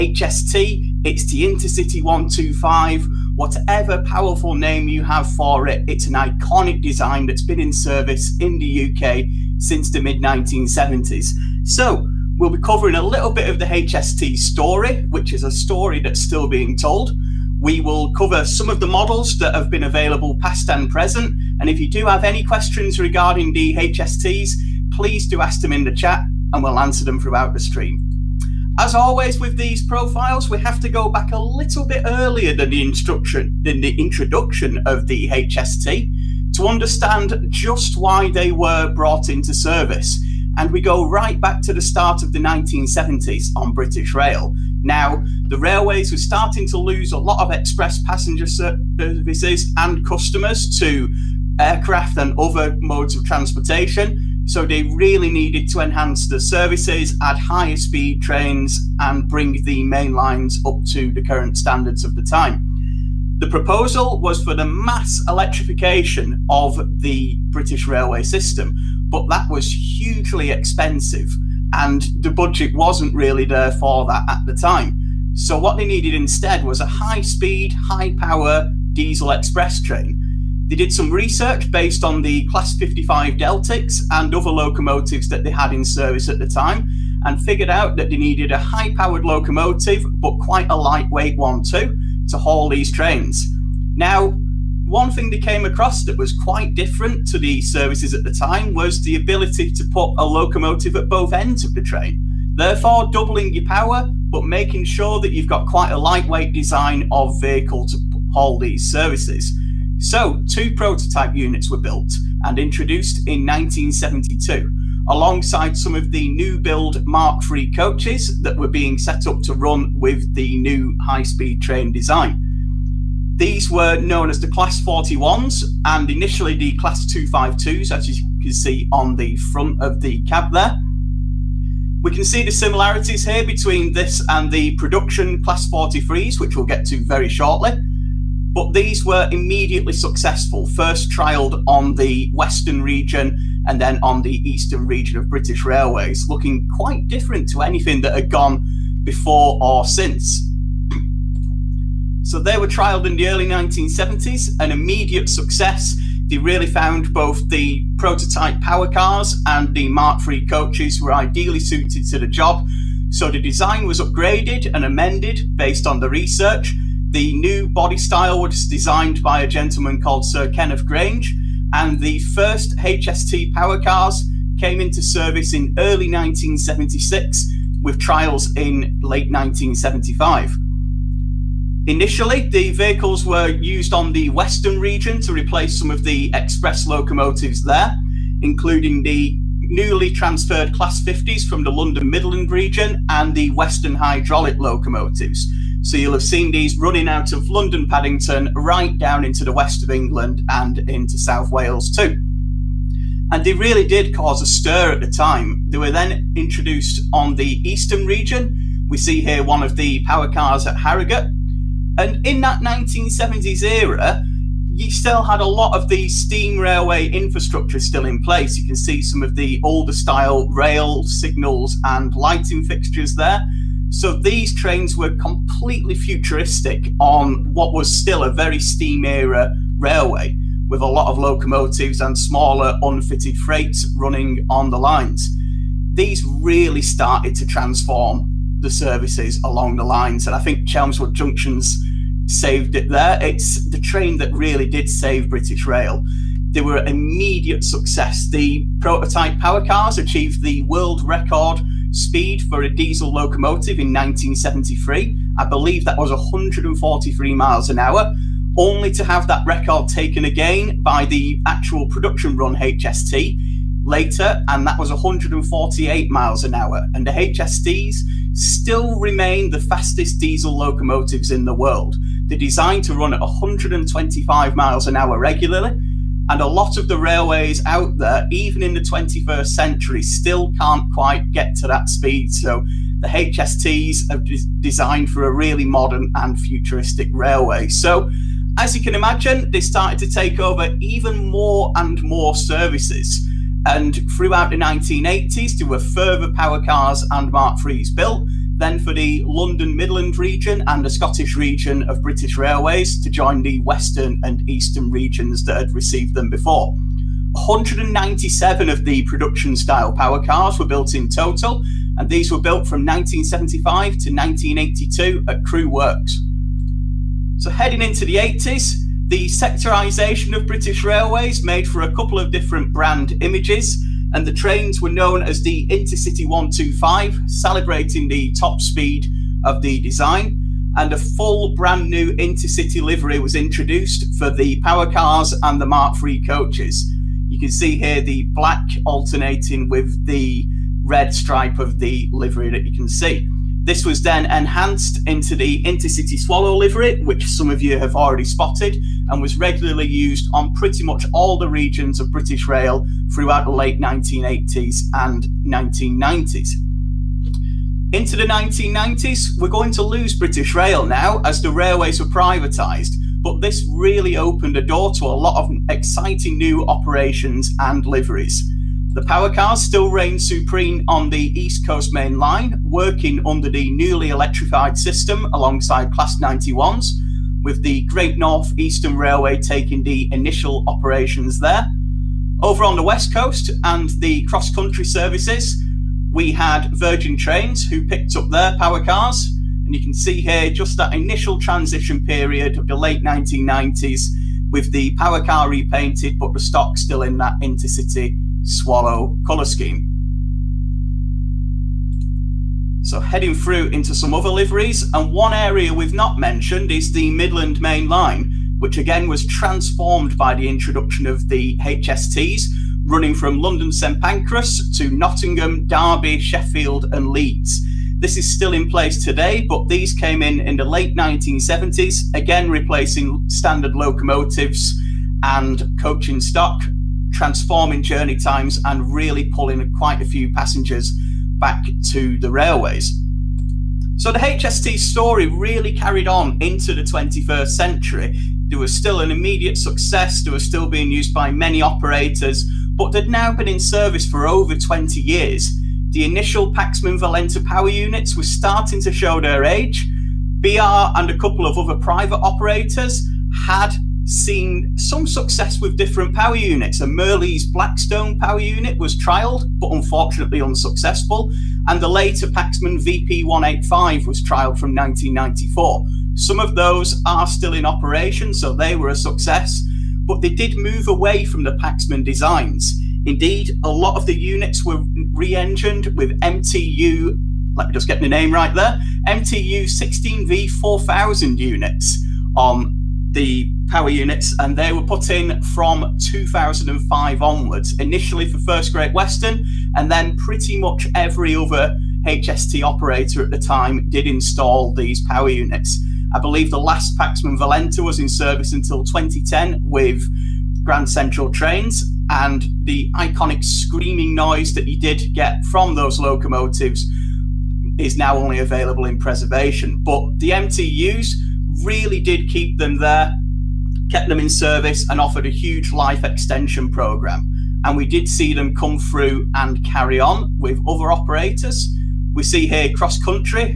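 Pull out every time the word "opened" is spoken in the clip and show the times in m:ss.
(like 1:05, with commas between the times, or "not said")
6:04.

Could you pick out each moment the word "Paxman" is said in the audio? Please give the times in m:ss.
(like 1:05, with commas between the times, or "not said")
7:26, 7:42, 7:51, 8:16.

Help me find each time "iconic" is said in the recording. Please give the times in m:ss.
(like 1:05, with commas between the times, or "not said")
0:06, 8:22.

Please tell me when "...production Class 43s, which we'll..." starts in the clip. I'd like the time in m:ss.
2:14.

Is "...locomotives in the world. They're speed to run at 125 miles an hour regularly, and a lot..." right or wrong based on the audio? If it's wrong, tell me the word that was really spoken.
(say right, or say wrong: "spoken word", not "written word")
wrong: "designed", not "speed".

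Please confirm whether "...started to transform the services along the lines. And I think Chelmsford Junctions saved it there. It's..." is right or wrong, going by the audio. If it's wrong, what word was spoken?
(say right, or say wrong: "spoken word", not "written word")
right.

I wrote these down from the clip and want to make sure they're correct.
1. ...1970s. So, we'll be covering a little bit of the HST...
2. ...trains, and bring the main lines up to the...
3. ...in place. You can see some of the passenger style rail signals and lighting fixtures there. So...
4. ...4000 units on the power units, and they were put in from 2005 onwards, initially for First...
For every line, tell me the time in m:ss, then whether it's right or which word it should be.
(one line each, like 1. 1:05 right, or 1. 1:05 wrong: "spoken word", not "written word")
1. 0:10 right
2. 0:58 right
3. 3:38 wrong: "older", not "passenger"
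4. 8:00 right.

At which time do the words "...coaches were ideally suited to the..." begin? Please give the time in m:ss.
2:40.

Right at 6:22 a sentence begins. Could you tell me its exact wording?
Over on the West Coast and the cross country services, we had Virgin Trains who picked up their power cars.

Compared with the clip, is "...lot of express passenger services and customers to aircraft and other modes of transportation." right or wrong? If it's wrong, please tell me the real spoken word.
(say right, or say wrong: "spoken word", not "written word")
right.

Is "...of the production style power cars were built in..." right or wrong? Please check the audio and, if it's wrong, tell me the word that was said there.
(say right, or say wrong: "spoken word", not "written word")
right.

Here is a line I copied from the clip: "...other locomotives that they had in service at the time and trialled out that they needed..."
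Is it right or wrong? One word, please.
wrong.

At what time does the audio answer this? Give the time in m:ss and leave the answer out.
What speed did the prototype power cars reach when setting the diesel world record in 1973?
4:16.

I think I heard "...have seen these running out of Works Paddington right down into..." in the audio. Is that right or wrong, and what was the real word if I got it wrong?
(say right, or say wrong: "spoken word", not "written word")
wrong: "London", not "Works".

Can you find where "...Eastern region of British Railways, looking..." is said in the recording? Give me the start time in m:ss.
2:24.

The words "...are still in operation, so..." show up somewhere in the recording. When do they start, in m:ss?
7:47.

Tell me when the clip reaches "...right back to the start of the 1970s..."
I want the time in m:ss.
0:41.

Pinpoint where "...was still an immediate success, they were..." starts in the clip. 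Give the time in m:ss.
7:18.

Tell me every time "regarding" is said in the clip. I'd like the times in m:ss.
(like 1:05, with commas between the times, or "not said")
0:22.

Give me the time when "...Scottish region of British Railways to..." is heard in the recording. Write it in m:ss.
5:00.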